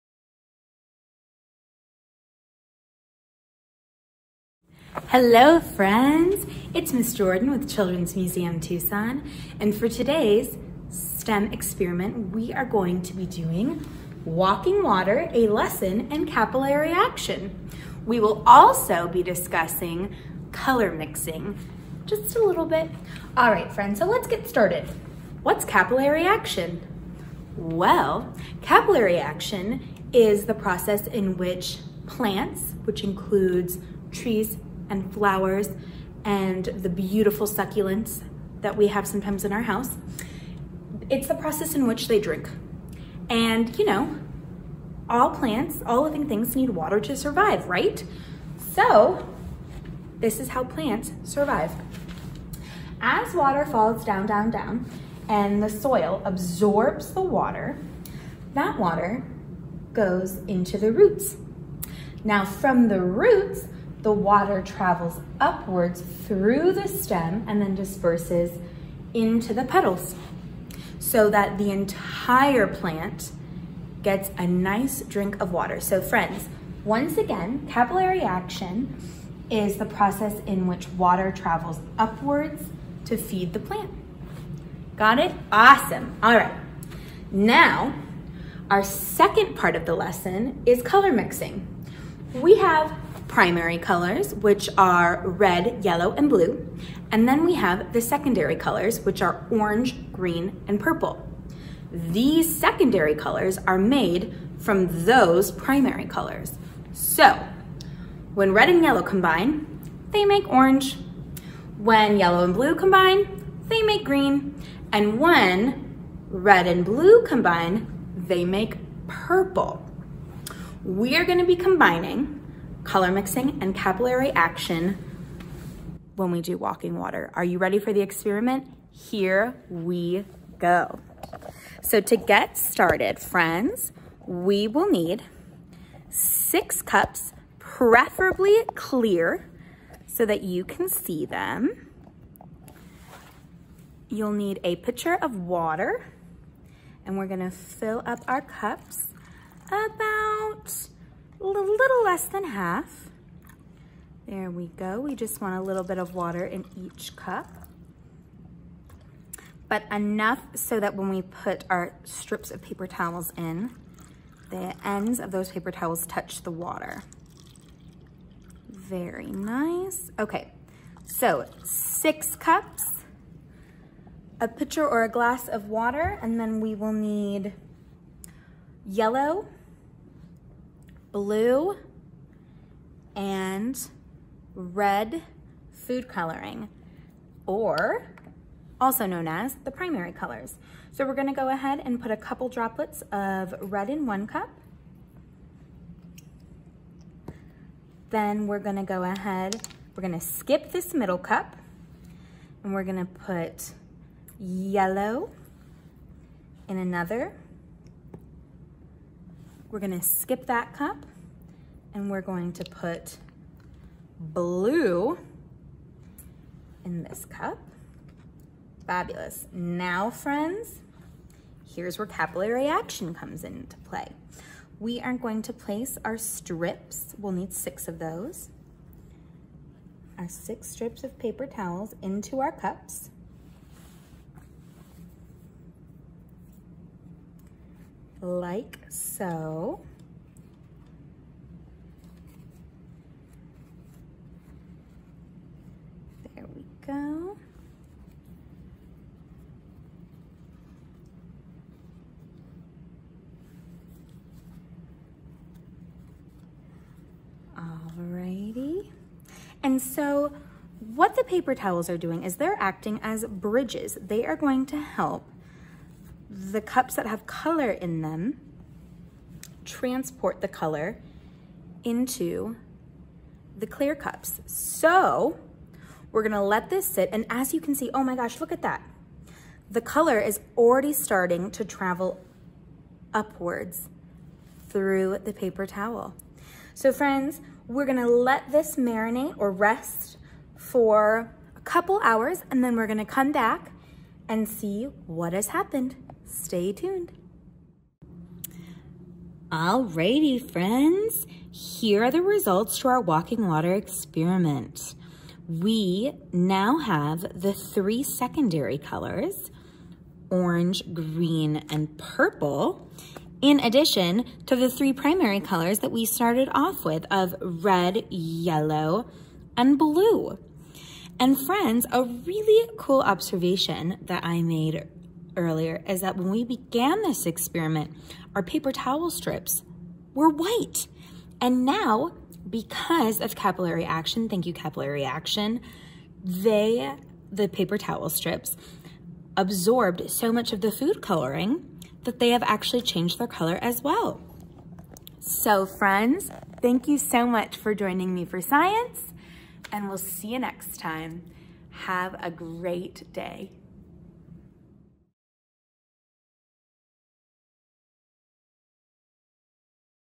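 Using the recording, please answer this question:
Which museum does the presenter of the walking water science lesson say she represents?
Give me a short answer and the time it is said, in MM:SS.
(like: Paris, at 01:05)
Children's Museum Tucson, at 00:07.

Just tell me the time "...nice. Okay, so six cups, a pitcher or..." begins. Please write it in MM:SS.
02:49.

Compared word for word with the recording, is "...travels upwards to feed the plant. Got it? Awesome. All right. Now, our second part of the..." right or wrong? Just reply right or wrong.
right.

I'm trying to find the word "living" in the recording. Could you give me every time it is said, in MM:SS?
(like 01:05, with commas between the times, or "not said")
00:46.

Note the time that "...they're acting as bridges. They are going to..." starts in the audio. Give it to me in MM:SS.
04:22.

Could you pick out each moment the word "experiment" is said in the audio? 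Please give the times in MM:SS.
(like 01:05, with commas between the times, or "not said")
00:11, 02:08, 05:03, 05:27.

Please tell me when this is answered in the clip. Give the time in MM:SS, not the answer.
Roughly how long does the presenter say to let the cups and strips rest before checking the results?
04:51.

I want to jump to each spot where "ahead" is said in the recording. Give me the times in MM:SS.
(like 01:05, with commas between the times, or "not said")
03:11, 03:19.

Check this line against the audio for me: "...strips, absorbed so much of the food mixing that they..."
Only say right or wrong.
wrong.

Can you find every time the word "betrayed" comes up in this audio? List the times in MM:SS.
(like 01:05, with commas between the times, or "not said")
not said.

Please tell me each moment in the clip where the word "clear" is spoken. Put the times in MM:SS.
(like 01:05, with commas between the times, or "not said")
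02:18, 04:33.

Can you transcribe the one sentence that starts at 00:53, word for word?
As water falls down, down, down, and the soil absorbs the water, that water goes into the roots.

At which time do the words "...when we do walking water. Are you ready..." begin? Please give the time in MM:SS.
02:06.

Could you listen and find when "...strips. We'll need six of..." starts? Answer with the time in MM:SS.
03:46.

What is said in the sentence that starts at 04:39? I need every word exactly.
The color is already starting to travel upwards through the paper towel.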